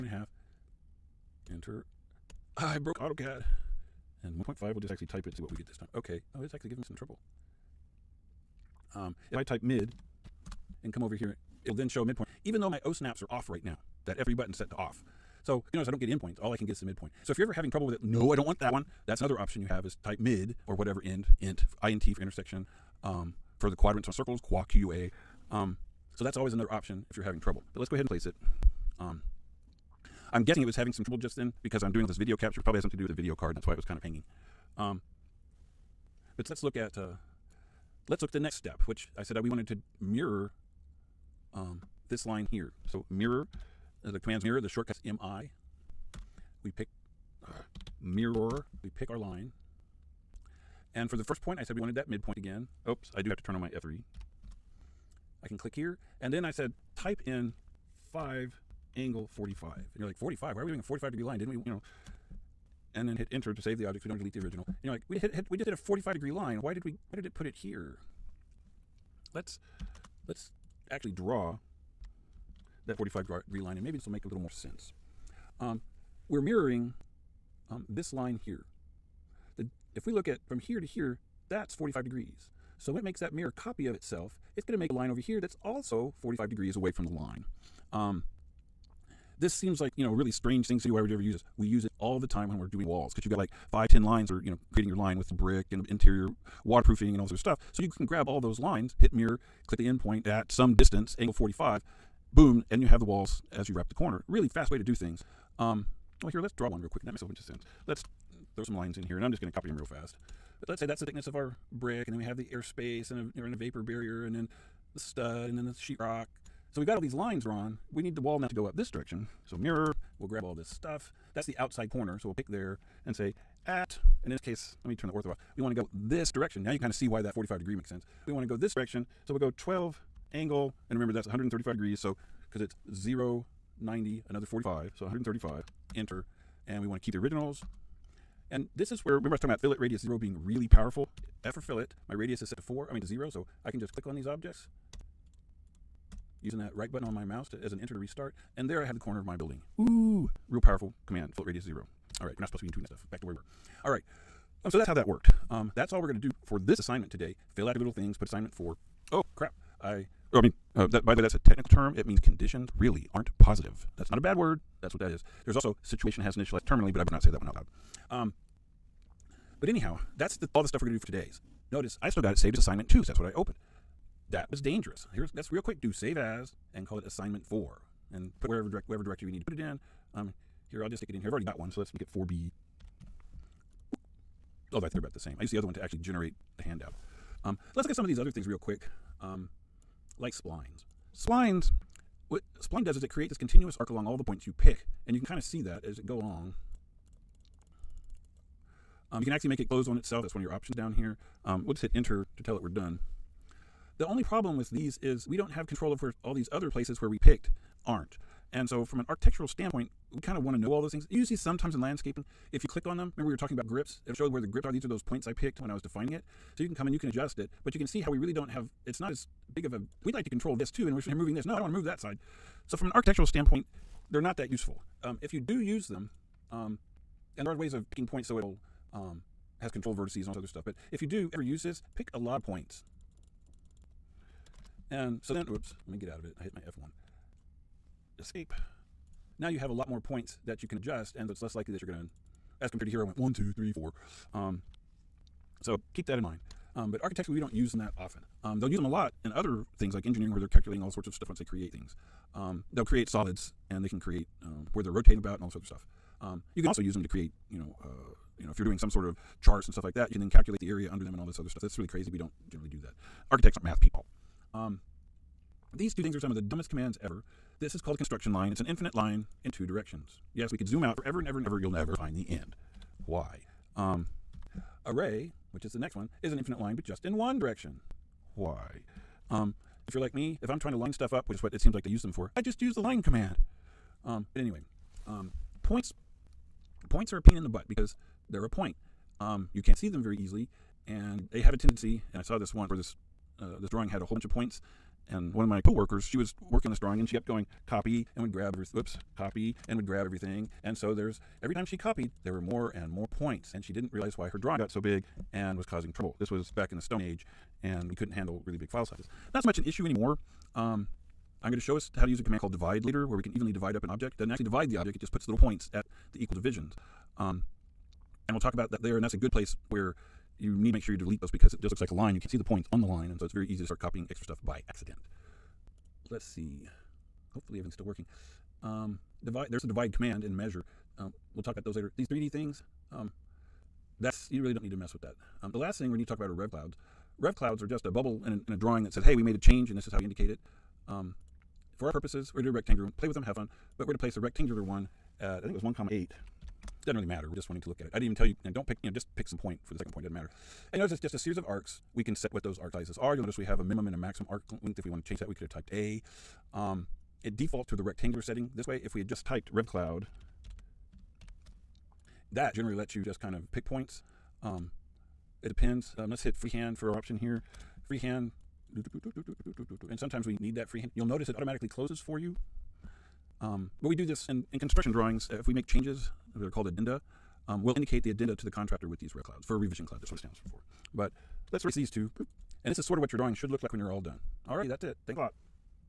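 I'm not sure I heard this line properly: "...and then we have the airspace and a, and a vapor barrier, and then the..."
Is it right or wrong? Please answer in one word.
right.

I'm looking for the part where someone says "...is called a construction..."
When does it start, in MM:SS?
04:27.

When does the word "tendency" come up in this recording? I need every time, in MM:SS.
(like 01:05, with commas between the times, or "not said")
04:51.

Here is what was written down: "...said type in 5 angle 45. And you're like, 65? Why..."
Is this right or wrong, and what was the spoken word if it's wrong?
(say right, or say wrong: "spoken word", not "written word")
wrong: "45", not "65".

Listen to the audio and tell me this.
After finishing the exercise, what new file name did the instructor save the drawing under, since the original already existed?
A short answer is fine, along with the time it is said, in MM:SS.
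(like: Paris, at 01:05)
4B, at 03:02.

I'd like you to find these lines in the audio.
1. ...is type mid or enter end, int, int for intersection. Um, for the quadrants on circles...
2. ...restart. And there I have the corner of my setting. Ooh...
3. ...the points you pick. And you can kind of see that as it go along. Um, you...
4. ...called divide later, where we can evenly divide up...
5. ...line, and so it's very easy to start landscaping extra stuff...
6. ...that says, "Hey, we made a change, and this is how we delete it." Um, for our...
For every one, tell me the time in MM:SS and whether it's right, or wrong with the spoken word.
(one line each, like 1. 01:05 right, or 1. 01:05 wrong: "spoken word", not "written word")
1. 00:19 wrong: "whatever", not "enter"
2. 02:27 wrong: "building", not "setting"
3. 03:14 right
4. 05:12 right
5. 05:22 wrong: "copying", not "landscaping"
6. 05:38 wrong: "indicate", not "delete".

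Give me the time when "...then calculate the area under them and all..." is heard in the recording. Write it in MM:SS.
04:20.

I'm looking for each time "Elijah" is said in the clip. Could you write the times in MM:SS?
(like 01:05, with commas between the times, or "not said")
not said.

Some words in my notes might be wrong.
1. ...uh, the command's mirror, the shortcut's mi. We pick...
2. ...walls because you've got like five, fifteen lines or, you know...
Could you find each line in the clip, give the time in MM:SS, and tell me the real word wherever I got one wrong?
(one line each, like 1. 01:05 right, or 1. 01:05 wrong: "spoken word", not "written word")
1. 00:44 right
2. 01:32 wrong: "ten", not "fifteen".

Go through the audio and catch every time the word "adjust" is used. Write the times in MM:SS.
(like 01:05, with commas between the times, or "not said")
03:37, 04:00.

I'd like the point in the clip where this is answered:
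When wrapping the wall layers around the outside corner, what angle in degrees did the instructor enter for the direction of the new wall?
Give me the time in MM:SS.
02:11.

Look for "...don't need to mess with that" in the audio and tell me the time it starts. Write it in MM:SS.
05:34.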